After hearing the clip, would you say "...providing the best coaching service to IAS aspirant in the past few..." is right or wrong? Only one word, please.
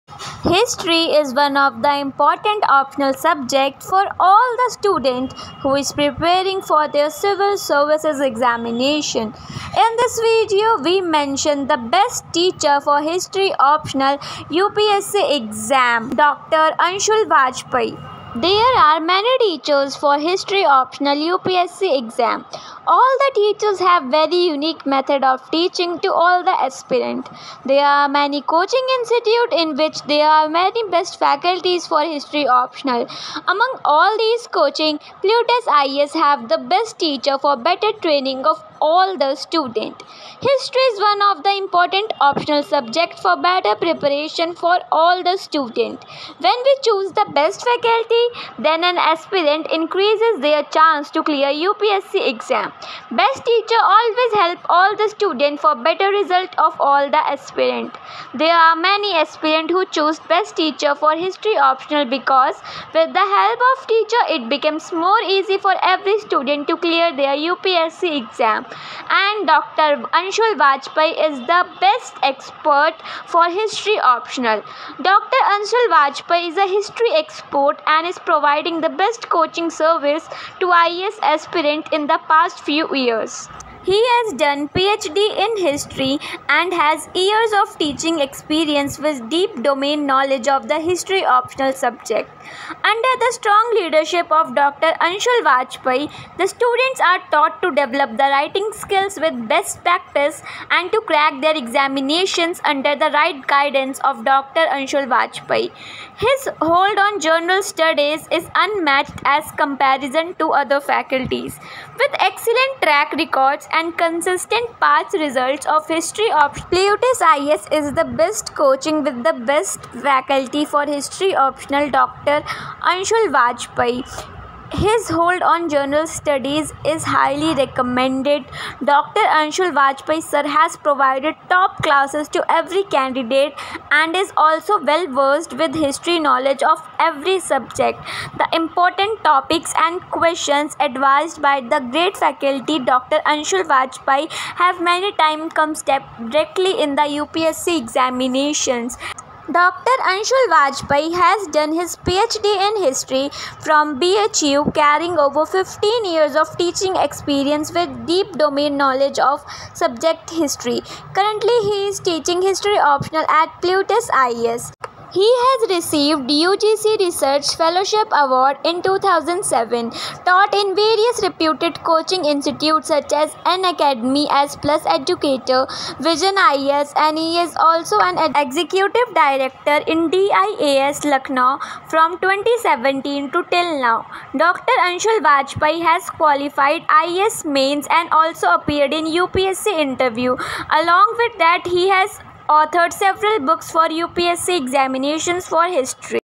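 right.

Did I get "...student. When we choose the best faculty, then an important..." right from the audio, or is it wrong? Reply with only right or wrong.
wrong.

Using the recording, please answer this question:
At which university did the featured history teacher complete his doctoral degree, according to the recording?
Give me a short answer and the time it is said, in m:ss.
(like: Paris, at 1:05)
BHU, at 2:33.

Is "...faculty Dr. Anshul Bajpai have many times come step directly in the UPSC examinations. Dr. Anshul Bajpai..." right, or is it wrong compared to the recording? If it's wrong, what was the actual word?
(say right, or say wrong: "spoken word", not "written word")
right.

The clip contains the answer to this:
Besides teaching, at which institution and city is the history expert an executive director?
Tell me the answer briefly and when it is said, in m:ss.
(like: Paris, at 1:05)
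DIAS Lucknow, at 3:00.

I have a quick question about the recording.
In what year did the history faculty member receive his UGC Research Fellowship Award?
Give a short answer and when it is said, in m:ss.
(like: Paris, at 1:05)
2007, at 2:48.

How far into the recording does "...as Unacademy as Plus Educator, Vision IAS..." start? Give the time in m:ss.
2:53.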